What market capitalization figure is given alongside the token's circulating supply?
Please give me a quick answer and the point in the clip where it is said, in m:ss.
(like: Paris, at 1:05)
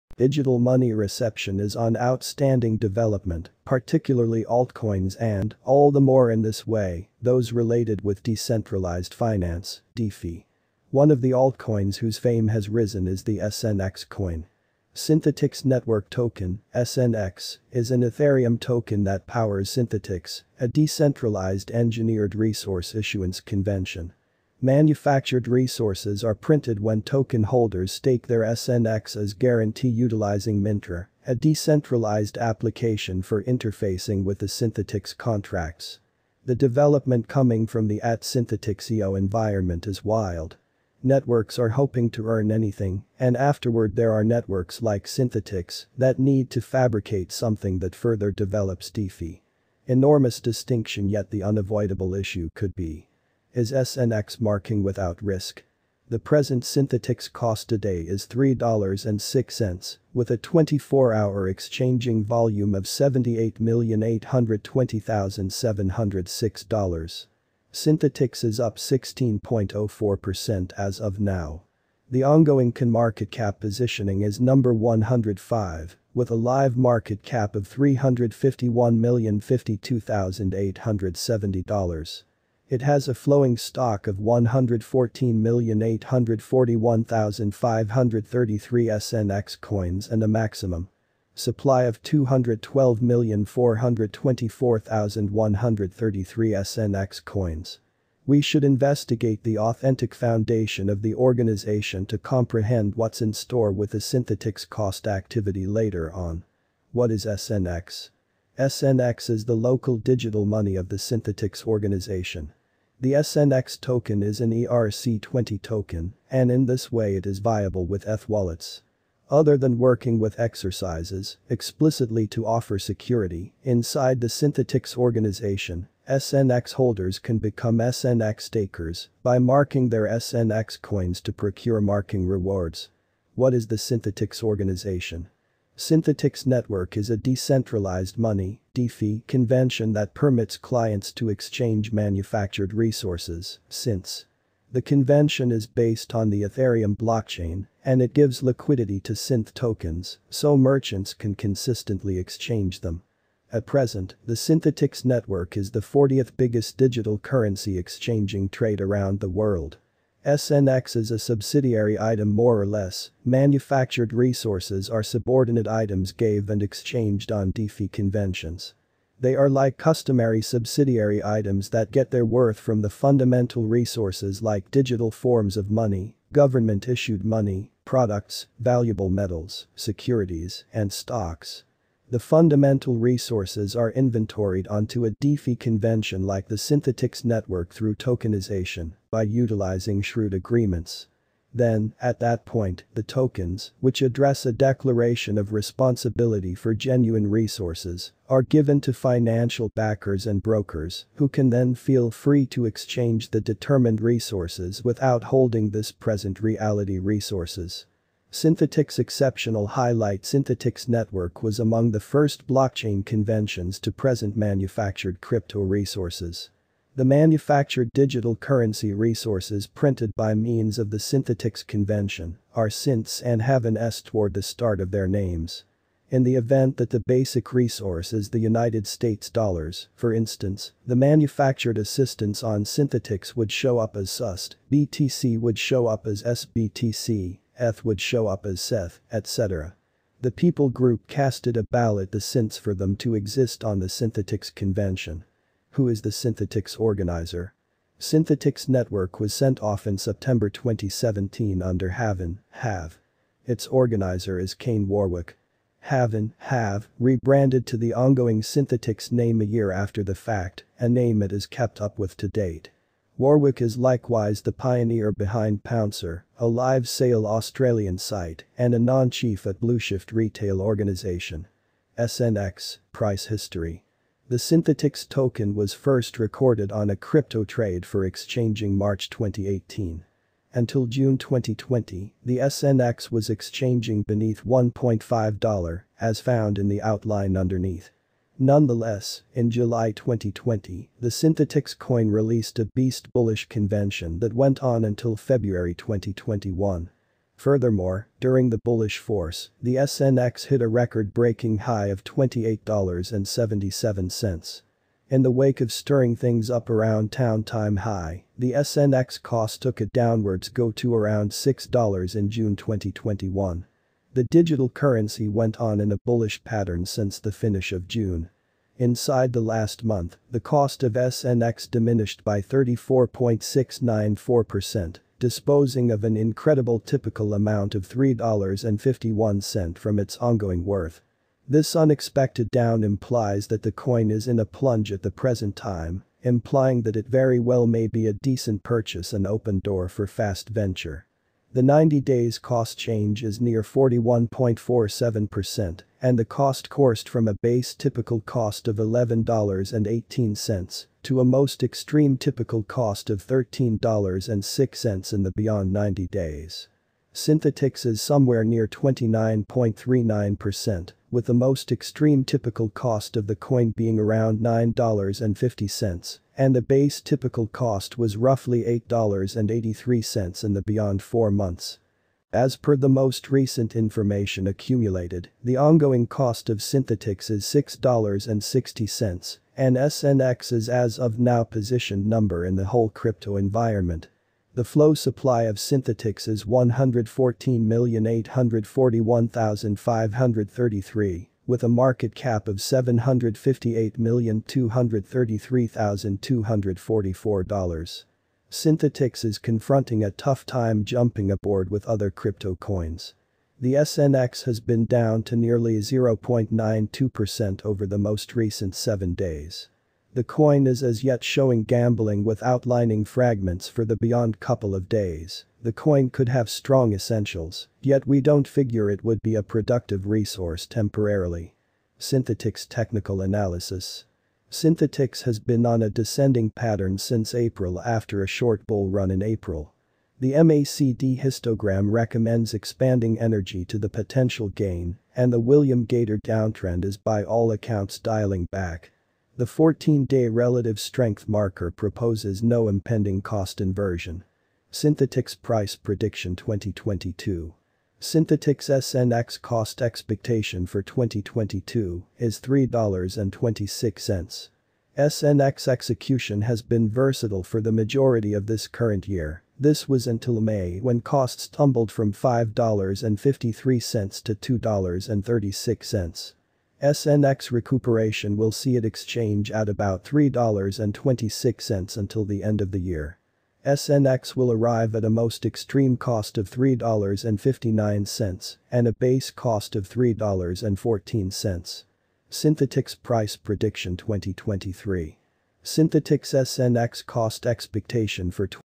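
$758,233,244, at 6:32.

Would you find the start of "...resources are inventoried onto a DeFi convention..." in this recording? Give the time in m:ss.
3:02.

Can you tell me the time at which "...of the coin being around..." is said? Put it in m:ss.
6:03.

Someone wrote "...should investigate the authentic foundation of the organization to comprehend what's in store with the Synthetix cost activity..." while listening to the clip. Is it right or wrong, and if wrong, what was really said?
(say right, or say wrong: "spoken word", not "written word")
right.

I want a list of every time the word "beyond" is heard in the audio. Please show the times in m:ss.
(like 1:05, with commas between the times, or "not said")
5:55, 6:10, 6:54.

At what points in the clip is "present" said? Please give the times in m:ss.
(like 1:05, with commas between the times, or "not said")
2:33, 3:25, 3:33, 5:35.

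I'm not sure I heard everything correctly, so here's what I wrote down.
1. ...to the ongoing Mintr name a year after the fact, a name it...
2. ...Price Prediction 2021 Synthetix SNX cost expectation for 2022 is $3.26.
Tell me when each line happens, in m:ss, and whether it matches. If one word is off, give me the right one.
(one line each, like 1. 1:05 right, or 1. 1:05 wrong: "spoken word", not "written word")
1. 4:17 wrong: "Synthetix", not "Mintr"
2. 7:25 wrong: "2022", not "2021".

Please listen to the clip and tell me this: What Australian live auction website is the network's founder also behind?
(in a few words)
Pouncer.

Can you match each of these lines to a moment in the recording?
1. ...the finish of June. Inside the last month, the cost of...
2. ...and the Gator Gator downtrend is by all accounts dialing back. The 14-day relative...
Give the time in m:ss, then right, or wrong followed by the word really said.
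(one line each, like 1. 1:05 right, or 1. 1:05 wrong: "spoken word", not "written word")
1. 5:17 right
2. 7:15 wrong: "William", not "Gator".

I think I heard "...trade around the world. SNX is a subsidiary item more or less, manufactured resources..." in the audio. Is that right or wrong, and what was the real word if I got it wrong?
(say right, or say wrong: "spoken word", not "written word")
right.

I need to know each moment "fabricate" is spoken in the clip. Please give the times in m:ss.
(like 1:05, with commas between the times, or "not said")
0:46.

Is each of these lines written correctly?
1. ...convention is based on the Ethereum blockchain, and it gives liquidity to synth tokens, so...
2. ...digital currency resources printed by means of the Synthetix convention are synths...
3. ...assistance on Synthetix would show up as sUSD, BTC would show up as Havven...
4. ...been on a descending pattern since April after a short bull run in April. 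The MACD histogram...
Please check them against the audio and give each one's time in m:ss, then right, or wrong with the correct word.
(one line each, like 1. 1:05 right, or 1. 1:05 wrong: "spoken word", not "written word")
1. 2:24 right
2. 3:37 right
3. 3:51 wrong: "SBTC", not "Havven"
4. 7:05 right.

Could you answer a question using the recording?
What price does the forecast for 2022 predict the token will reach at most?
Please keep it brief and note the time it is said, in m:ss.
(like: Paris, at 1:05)
$3.59, at 7:56.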